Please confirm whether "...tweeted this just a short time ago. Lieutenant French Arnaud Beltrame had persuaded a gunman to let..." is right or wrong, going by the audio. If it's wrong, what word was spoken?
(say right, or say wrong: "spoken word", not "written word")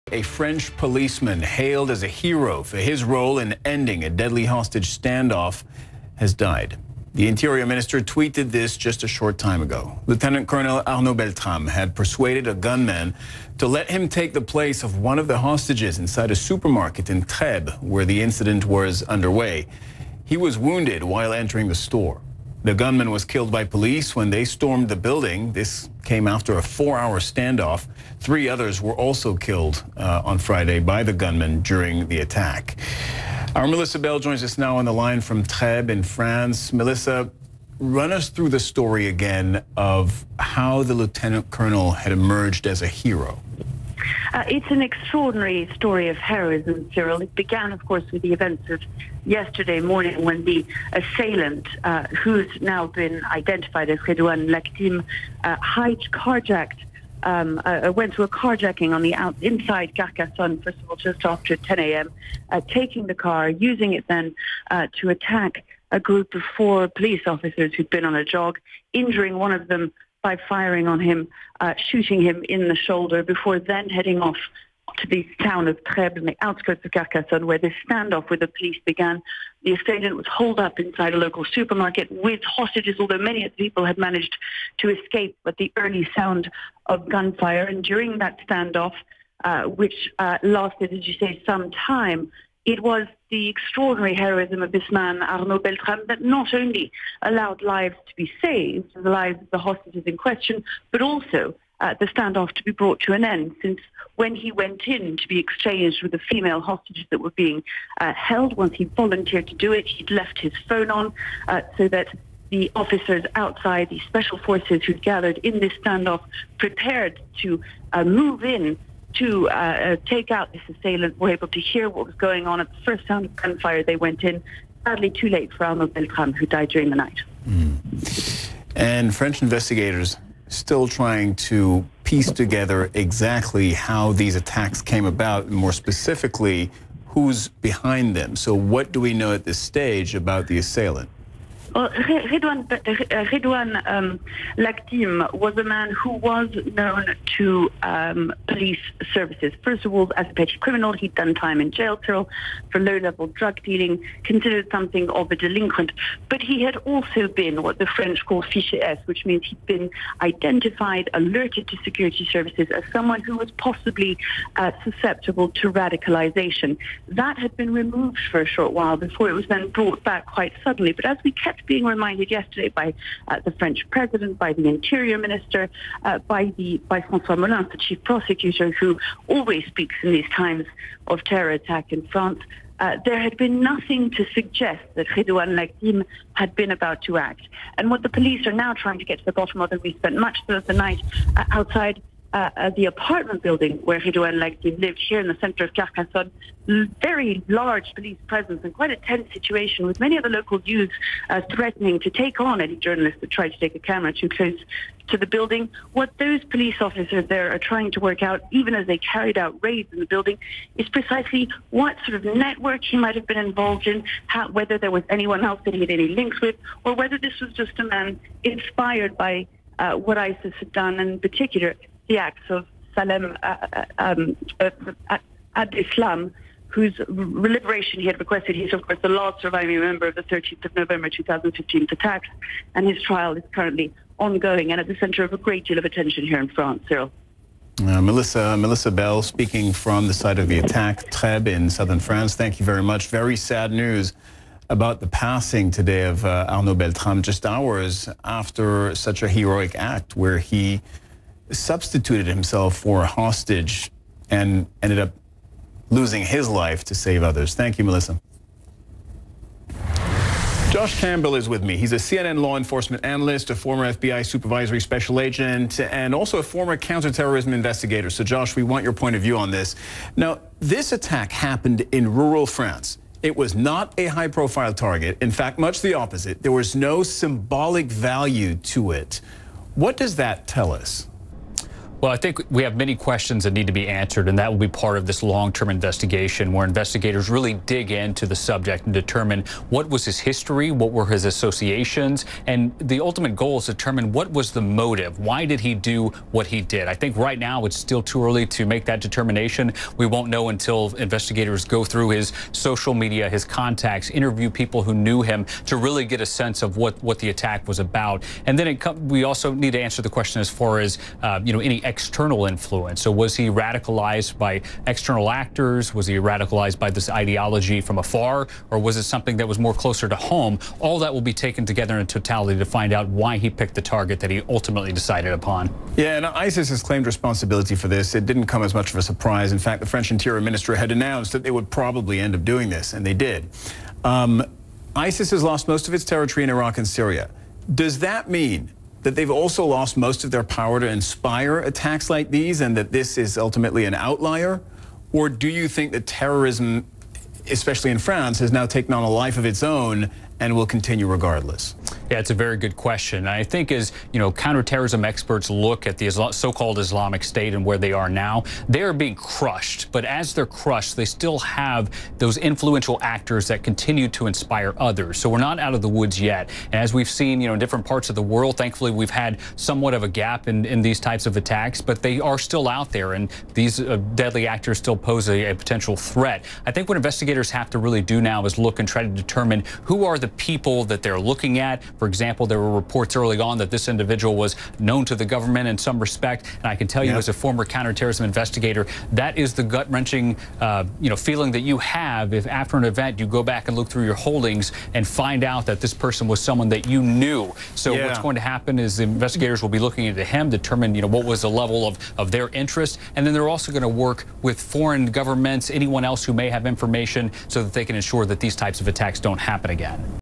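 wrong: "Colonel", not "French".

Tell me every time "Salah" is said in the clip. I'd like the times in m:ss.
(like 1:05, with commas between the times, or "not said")
3:42.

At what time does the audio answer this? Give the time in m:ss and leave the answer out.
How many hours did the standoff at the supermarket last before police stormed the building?
0:26.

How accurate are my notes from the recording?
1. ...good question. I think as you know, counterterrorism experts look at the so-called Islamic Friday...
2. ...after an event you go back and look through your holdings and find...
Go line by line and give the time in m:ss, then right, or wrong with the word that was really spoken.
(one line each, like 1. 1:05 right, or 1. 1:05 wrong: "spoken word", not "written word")
1. 5:52 wrong: "State", not "Friday"
2. 6:32 right.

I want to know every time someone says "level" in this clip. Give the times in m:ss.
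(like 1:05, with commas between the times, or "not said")
2:32, 6:41.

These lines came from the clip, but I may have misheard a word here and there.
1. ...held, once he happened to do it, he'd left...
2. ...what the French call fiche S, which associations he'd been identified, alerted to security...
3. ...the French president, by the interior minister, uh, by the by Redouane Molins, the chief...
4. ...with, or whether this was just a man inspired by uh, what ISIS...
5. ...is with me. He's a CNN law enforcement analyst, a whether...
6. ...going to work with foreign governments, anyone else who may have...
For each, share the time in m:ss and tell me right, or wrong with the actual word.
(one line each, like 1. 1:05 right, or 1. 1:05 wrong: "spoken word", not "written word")
1. 1:48 wrong: "volunteered", not "happened"
2. 2:37 wrong: "means", not "associations"
3. 2:53 wrong: "François", not "Redouane"
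4. 3:36 right
5. 4:21 wrong: "former", not "whether"
6. 6:43 right.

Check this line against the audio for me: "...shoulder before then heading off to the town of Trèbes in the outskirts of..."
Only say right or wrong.
right.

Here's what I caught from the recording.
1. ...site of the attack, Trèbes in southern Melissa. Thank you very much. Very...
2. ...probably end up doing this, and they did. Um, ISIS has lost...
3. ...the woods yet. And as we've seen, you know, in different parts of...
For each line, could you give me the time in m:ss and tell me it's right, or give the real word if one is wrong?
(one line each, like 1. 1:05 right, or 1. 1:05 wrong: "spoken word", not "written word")
1. 4:00 wrong: "France", not "Melissa"
2. 5:31 right
3. 6:05 right.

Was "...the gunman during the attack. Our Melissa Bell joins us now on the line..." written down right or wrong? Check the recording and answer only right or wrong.
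right.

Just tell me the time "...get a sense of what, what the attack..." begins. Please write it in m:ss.
5:06.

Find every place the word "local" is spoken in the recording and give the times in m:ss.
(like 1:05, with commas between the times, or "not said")
1:21, 3:20.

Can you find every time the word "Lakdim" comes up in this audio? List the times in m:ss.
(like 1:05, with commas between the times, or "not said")
0:54, 3:05, 3:14.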